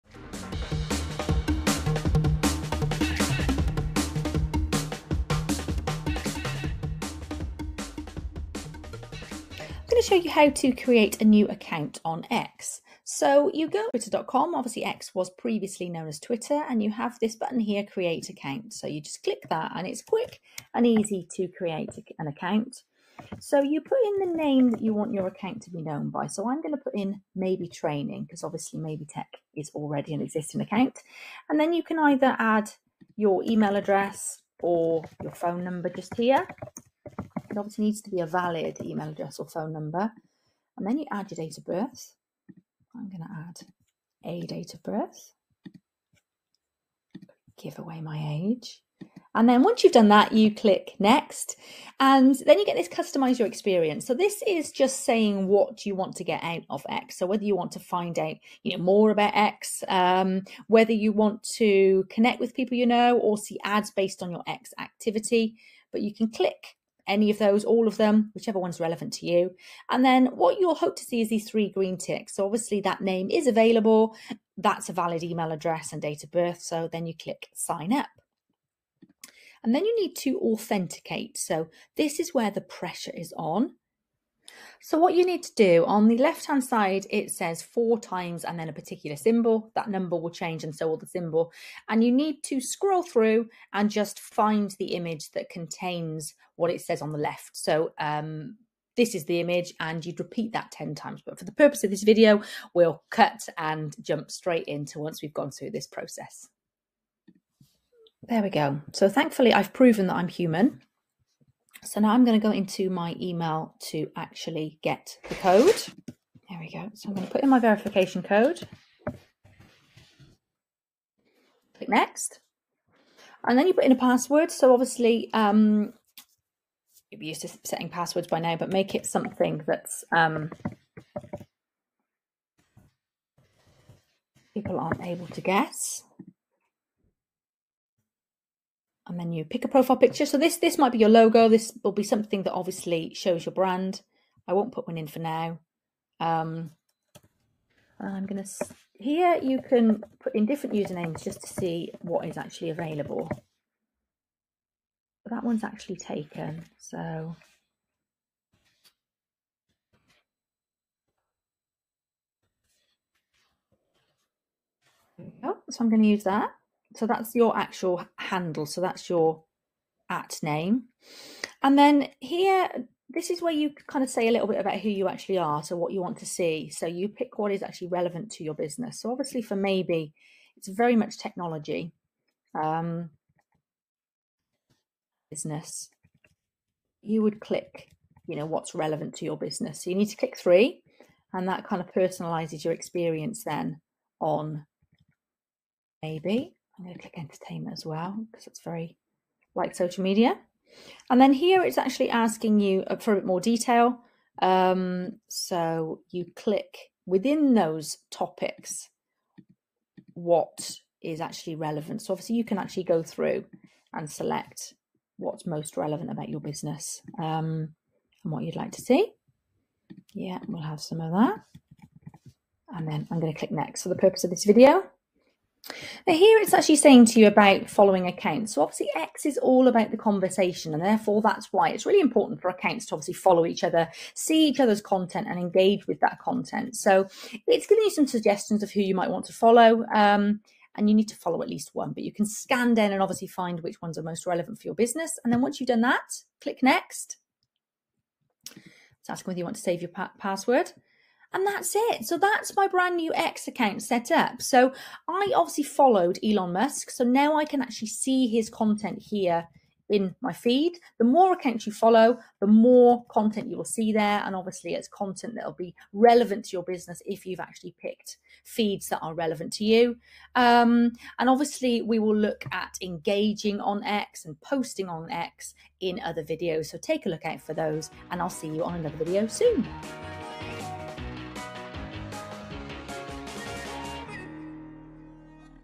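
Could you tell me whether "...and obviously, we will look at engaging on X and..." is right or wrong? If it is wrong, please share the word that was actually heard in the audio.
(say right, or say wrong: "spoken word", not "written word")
right.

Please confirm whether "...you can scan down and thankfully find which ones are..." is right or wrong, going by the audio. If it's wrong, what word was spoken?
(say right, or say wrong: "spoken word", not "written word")
wrong: "obviously", not "thankfully".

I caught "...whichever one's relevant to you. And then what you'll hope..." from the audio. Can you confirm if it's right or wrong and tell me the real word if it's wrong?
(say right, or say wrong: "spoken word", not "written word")
right.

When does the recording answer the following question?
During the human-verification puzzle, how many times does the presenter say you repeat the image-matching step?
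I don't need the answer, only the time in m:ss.
1:40.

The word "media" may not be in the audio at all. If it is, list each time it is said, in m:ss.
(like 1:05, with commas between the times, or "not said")
3:20.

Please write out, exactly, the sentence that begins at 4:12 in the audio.
So that's my brand new X account set up.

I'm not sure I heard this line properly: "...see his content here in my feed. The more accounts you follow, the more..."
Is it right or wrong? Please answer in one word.
right.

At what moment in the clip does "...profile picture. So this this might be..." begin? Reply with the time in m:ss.
2:19.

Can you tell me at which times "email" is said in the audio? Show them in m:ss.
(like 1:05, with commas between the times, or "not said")
0:33, 0:38, 1:15, 1:53.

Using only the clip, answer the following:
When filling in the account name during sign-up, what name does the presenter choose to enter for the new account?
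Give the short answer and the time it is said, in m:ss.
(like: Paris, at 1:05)
training, at 0:27.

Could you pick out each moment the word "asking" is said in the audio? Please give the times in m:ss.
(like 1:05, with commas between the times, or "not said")
3:22, 4:09.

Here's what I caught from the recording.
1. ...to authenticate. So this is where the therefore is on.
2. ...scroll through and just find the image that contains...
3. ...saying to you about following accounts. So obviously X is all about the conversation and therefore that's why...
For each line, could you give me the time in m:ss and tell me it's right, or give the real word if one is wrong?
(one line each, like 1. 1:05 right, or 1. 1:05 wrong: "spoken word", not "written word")
1. 1:20 wrong: "pressure", not "therefore"
2. 1:32 right
3. 3:46 right.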